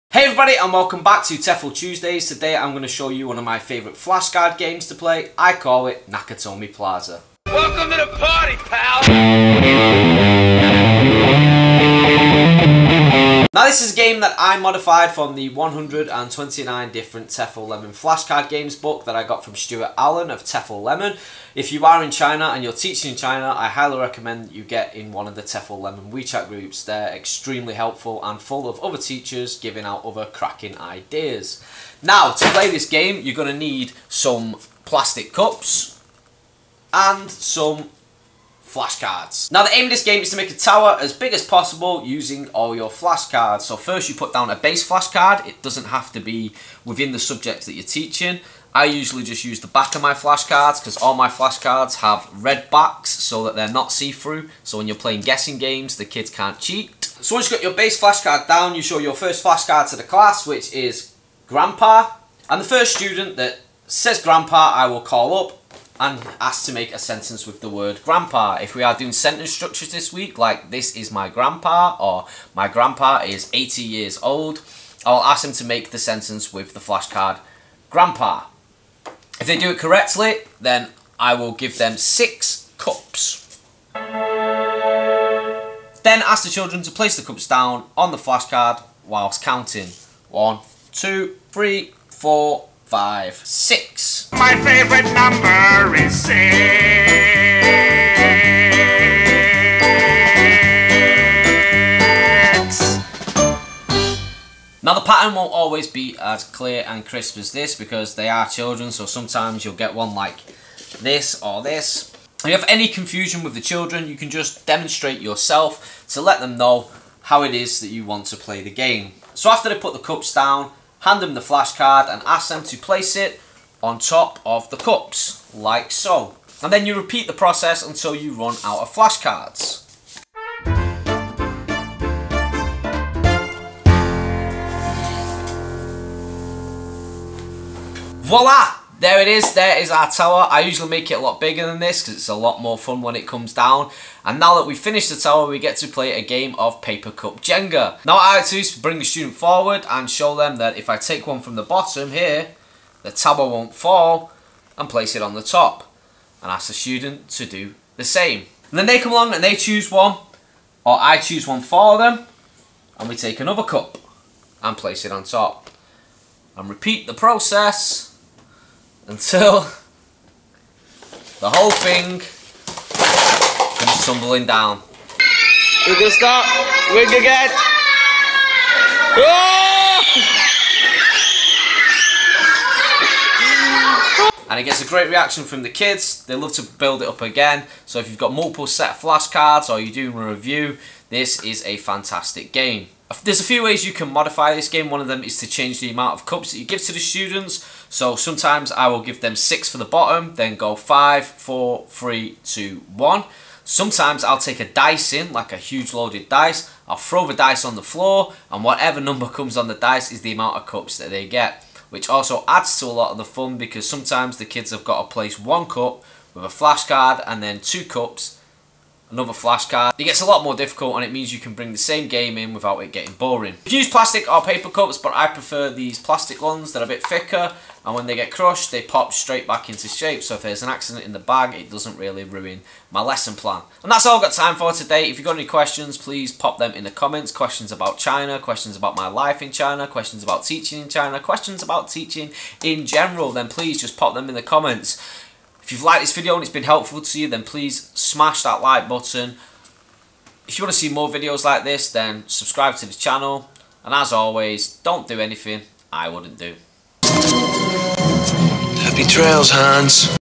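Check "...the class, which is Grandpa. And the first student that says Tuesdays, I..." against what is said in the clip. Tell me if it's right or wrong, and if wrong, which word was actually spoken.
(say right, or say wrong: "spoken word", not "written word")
wrong: "Grandpa", not "Tuesdays".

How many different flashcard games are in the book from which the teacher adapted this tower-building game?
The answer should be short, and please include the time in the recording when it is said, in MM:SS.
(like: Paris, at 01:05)
129, at 00:15.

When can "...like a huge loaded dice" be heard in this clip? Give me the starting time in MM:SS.
03:25.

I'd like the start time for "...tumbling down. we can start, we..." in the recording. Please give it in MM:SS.
02:54.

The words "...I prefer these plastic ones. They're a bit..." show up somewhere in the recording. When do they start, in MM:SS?
03:45.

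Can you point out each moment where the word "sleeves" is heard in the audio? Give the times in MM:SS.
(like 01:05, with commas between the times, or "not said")
not said.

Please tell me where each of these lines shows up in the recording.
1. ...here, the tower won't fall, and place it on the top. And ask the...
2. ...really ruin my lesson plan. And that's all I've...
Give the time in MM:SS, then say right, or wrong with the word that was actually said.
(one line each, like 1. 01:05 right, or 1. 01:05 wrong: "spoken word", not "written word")
1. 02:32 right
2. 03:51 right.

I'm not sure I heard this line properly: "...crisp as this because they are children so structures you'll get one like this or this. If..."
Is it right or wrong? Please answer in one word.
wrong.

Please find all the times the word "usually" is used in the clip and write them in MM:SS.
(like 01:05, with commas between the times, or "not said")
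00:48, 02:20.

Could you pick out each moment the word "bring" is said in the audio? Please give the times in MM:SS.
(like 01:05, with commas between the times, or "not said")
02:28, 03:41.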